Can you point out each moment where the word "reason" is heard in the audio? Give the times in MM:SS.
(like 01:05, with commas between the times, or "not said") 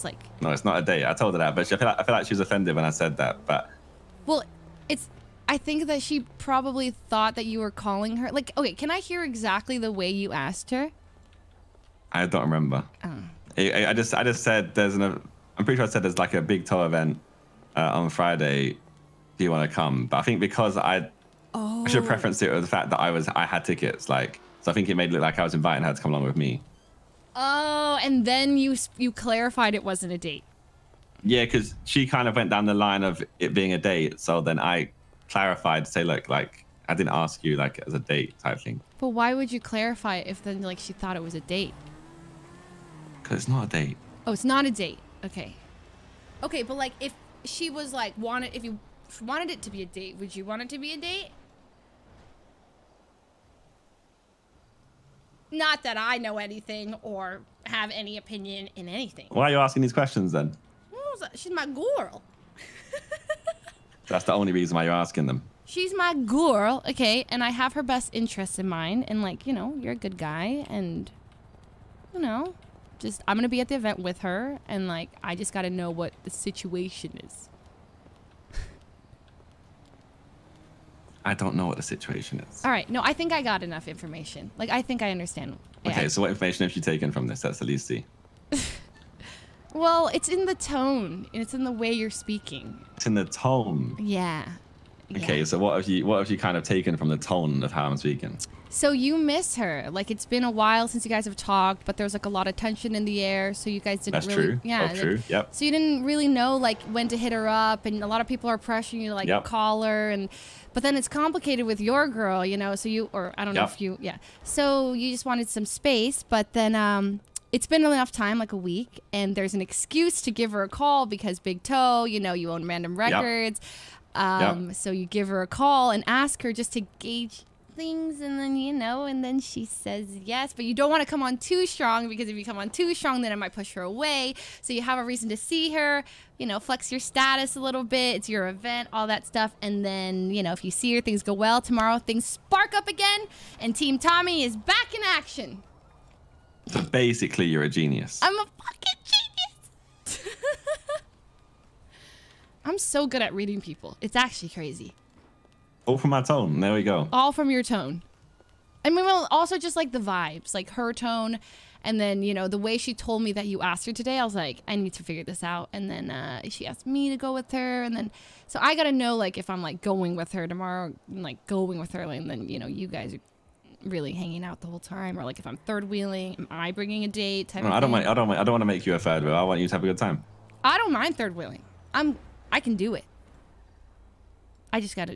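01:04, 02:15.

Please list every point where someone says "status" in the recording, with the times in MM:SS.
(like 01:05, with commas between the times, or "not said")
02:17.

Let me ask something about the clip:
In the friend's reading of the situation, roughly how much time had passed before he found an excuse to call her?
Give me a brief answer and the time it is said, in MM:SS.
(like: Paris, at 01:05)
a week, at 01:58.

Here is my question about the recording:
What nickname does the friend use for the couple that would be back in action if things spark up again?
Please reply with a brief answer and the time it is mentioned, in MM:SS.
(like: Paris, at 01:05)
Team Tommy, at 02:23.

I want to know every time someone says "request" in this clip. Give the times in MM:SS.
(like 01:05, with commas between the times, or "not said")
not said.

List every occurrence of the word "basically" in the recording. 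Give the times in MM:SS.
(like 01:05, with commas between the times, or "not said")
02:26.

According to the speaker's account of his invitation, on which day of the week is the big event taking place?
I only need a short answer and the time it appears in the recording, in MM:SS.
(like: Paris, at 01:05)
Friday, at 00:18.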